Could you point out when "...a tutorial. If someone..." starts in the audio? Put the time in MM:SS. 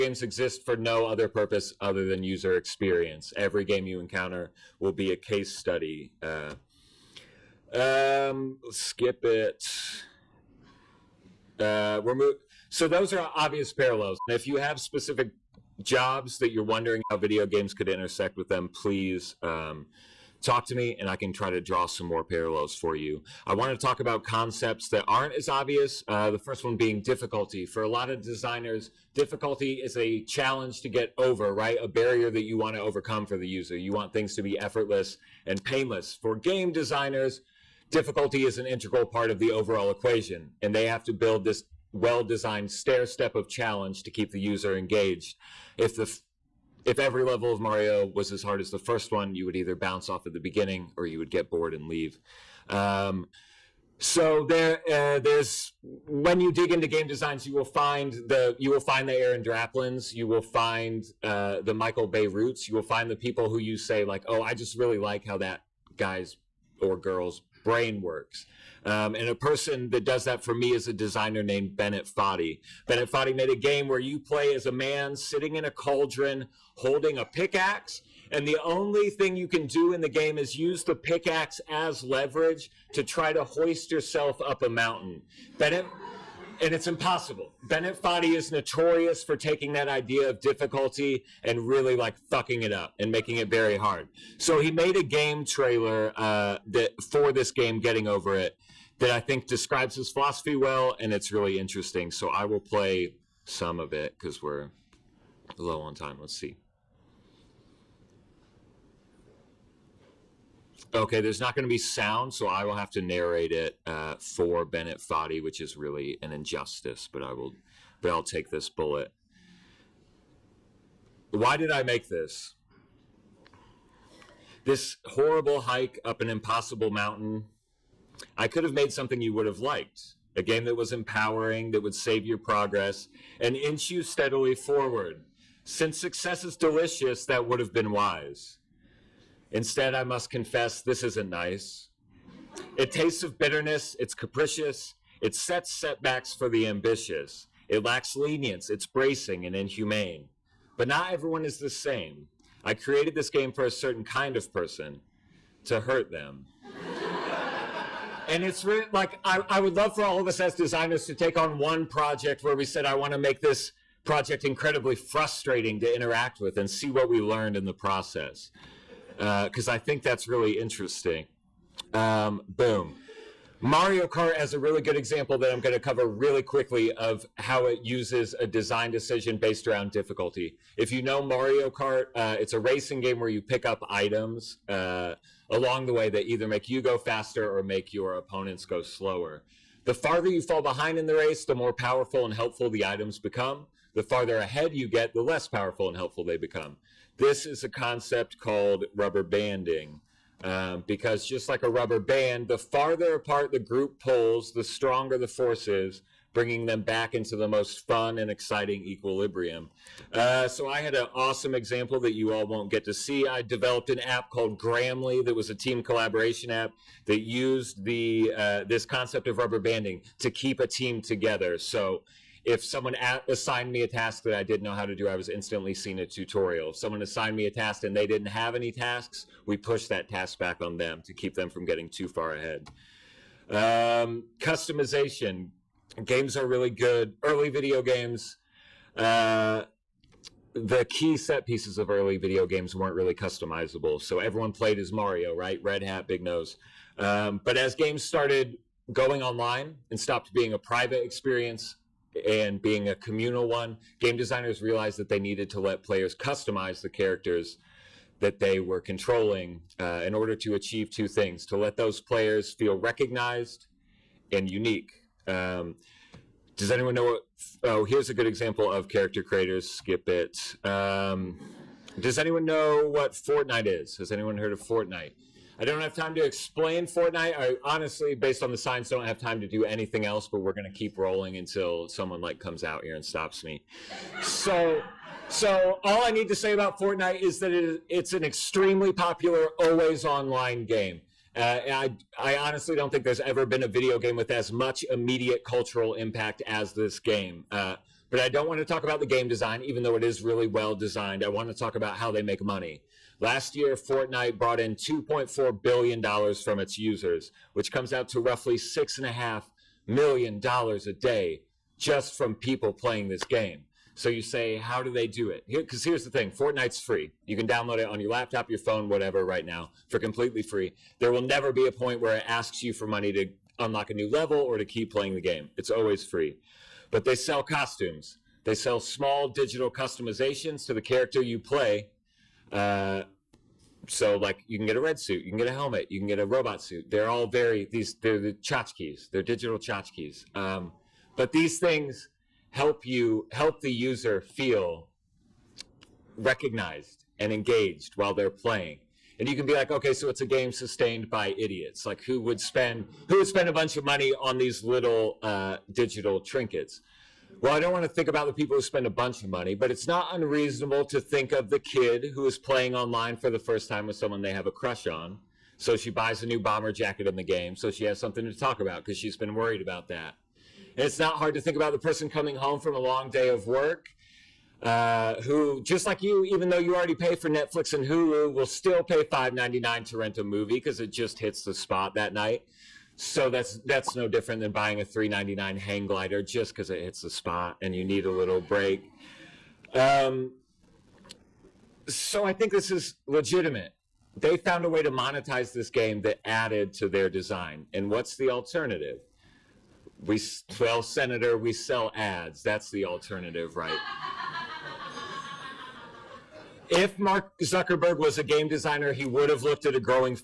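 03:45.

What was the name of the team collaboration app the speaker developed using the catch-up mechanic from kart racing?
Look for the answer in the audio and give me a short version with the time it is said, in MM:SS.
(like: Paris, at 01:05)
Gramly, at 03:34.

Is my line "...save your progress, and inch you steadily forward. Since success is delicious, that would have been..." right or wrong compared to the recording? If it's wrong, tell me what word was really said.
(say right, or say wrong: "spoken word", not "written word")
right.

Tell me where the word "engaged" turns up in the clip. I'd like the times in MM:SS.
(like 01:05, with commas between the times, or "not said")
00:44, 05:47.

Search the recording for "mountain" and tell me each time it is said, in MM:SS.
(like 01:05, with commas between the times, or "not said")
01:24, 02:06.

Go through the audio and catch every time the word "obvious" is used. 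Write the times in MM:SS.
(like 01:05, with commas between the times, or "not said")
00:13, 00:25.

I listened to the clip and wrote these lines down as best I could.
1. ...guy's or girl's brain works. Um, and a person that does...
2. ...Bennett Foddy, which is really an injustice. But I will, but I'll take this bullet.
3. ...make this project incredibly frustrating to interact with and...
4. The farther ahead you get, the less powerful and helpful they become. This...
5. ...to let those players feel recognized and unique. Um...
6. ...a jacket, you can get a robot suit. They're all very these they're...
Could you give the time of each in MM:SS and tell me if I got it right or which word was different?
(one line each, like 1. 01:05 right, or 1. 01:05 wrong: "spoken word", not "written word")
1. 01:05 right
2. 01:54 right
3. 02:43 right
4. 03:13 right
5. 04:21 right
6. 05:35 wrong: "helmet", not "jacket".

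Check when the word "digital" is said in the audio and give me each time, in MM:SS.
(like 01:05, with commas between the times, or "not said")
05:29, 05:39, 05:55.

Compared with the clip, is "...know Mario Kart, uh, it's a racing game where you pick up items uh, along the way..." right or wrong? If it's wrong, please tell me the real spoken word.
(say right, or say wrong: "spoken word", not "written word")
right.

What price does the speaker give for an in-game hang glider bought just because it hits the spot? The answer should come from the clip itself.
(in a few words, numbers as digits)
$3.99.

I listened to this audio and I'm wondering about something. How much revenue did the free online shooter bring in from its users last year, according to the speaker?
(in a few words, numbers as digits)
$2.4 billion.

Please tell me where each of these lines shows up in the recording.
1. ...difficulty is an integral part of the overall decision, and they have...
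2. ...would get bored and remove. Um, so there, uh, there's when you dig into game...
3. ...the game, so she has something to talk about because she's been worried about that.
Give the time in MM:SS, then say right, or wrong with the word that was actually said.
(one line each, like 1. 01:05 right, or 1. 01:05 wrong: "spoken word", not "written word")
1. 00:37 wrong: "equation", not "decision"
2. 00:51 wrong: "leave", not "remove"
3. 06:07 right.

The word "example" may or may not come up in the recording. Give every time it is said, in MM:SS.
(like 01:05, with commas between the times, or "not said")
02:54, 03:31, 04:28.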